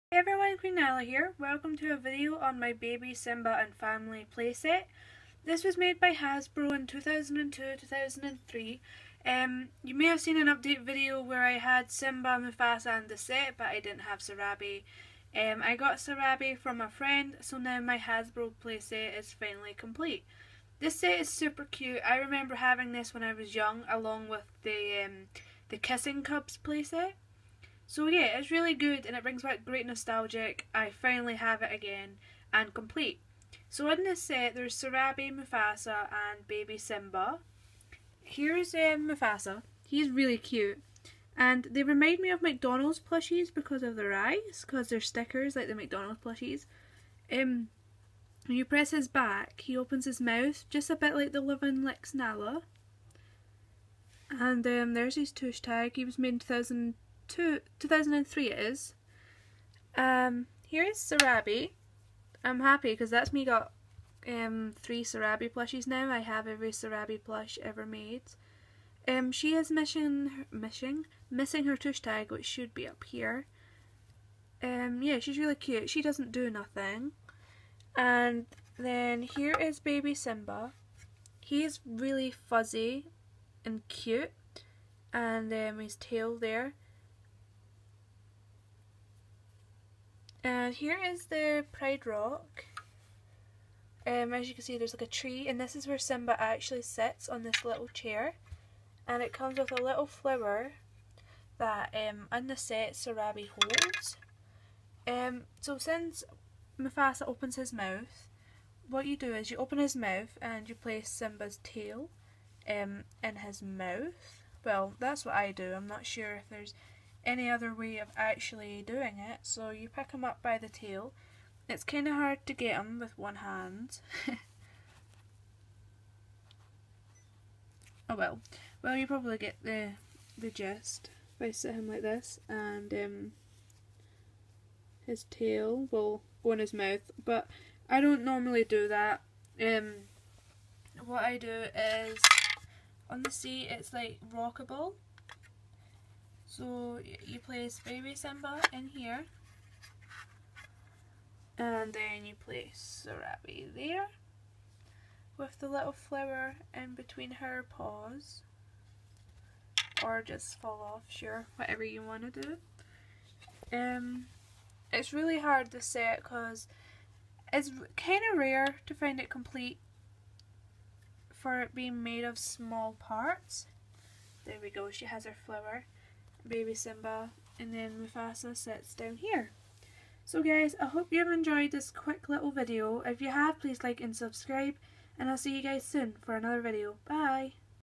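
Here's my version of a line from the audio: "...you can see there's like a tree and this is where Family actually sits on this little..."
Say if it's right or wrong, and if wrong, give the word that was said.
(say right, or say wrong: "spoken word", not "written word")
wrong: "Simba", not "Family".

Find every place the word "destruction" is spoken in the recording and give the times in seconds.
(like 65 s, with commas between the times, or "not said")
not said.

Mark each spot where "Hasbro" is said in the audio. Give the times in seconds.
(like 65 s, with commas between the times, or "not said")
6 s, 17 s.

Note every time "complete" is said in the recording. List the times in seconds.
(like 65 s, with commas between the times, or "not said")
19 s, 32 s, 169 s.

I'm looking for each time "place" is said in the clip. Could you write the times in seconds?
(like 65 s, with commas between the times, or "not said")
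110 s, 147 s, 152 s.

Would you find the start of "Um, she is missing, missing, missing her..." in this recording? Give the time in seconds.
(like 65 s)
69 s.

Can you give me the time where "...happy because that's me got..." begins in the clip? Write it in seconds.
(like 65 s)
62 s.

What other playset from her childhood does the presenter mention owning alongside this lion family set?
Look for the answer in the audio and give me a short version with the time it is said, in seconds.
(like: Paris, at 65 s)
Kissing Cubs playset, at 25 s.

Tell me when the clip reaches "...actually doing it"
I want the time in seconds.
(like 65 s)
118 s.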